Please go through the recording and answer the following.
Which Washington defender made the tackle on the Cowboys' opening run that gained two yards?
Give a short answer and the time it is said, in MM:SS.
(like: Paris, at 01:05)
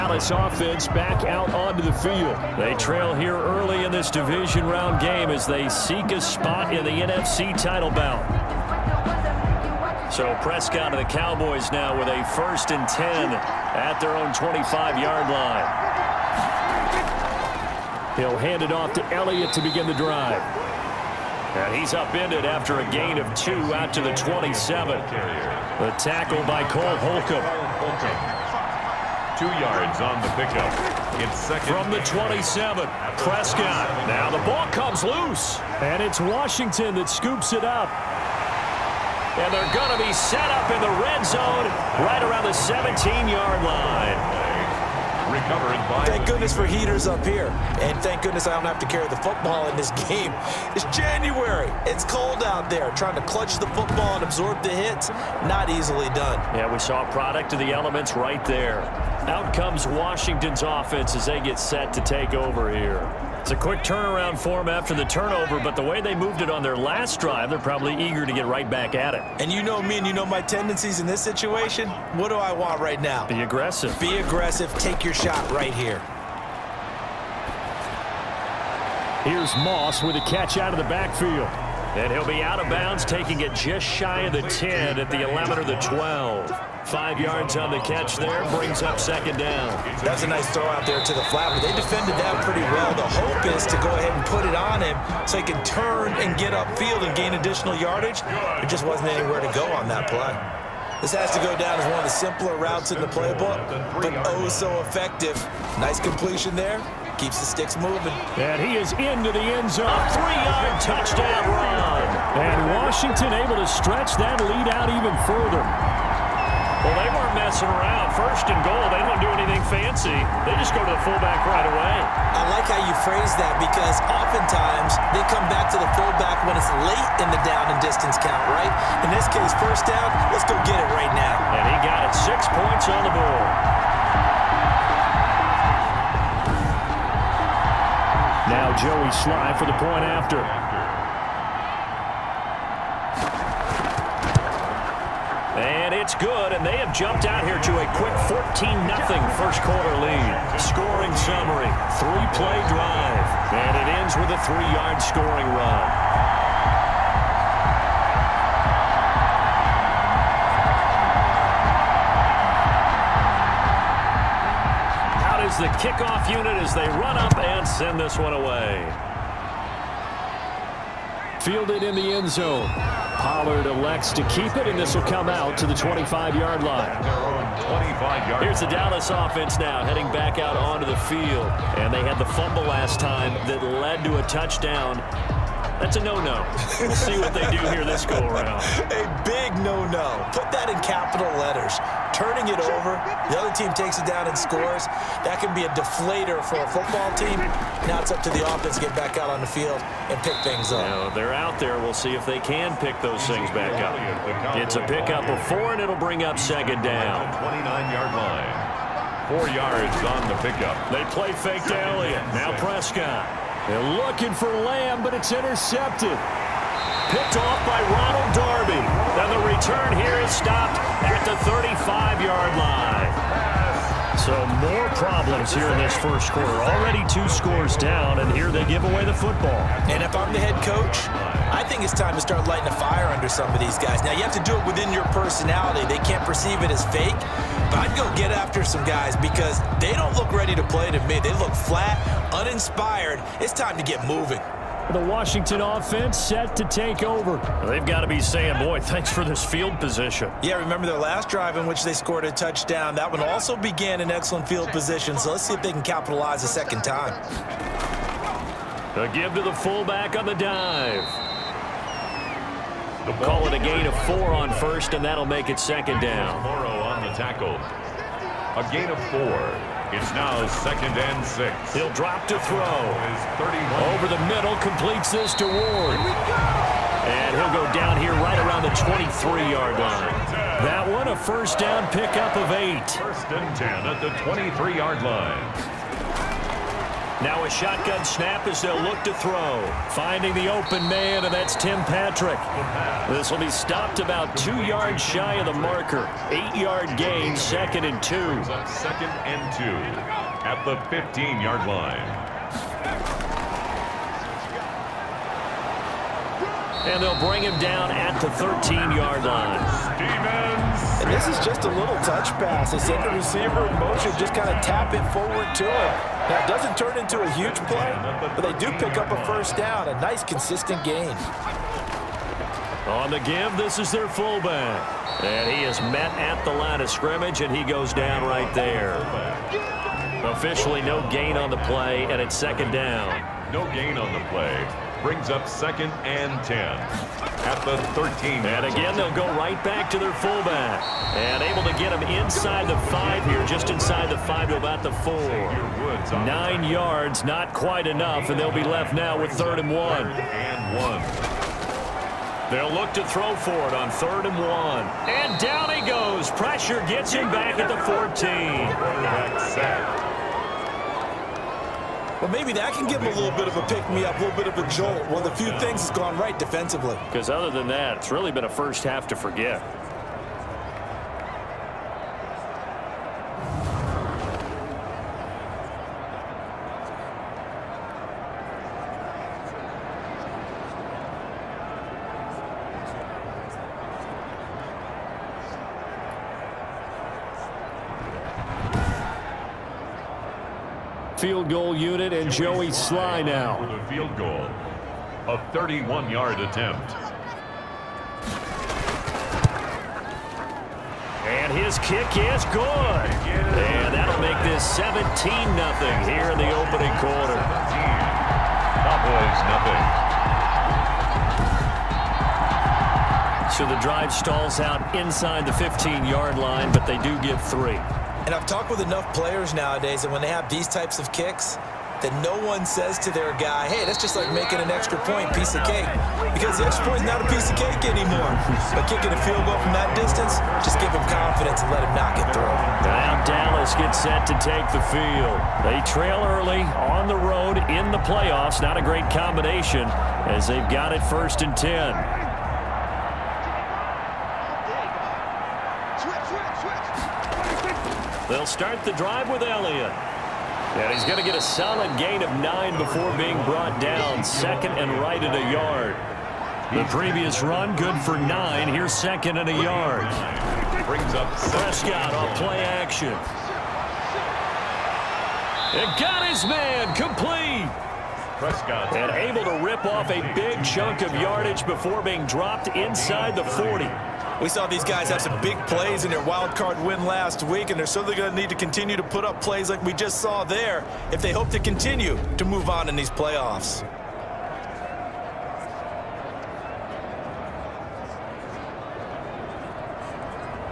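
Cole Holcomb, at 00:26.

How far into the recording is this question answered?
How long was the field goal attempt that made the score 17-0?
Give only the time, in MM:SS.
06:35.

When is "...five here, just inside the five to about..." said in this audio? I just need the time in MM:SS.
05:42.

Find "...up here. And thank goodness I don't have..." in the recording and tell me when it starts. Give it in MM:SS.
00:47.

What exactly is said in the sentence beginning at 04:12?
That one also began in excellent field position, so let's see if they can capitalize a second time.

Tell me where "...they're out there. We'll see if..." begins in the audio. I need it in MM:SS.
03:21.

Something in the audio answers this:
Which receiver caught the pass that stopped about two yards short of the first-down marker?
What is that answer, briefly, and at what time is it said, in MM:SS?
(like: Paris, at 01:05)
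Tim Patrick, at 04:51.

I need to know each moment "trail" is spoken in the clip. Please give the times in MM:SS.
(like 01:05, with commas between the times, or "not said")
00:02, 07:15.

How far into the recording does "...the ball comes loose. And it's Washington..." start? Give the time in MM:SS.
00:34.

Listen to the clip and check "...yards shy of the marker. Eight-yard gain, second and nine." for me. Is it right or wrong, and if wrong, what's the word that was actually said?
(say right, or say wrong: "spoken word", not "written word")
wrong: "two", not "nine".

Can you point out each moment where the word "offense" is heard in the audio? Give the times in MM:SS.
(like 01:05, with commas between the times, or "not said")
00:00, 01:00, 02:59, 03:18, 04:05.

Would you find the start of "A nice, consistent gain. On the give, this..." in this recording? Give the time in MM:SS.
05:19.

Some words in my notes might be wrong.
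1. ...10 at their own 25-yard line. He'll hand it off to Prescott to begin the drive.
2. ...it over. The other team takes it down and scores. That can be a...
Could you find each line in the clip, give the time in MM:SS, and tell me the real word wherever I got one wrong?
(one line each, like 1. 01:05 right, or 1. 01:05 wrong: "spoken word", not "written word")
1. 00:12 wrong: "Elliott", not "Prescott"
2. 03:12 right.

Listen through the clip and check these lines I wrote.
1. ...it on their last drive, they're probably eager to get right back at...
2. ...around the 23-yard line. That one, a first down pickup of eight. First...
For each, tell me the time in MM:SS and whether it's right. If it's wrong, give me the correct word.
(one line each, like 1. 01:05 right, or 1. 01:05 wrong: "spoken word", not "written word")
1. 01:06 right
2. 04:38 right.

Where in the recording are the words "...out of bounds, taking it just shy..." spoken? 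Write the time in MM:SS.
01:22.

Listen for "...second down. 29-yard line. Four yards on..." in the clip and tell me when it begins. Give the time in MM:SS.
03:26.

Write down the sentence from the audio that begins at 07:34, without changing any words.
Second and right at a yard.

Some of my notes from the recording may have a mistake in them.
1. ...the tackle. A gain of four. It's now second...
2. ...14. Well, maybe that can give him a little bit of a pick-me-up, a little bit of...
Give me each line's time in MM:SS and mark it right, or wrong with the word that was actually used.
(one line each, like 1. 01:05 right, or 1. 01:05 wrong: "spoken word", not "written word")
1. 04:27 right
2. 05:58 right.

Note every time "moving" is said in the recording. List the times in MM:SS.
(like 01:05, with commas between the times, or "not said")
01:47, 04:04.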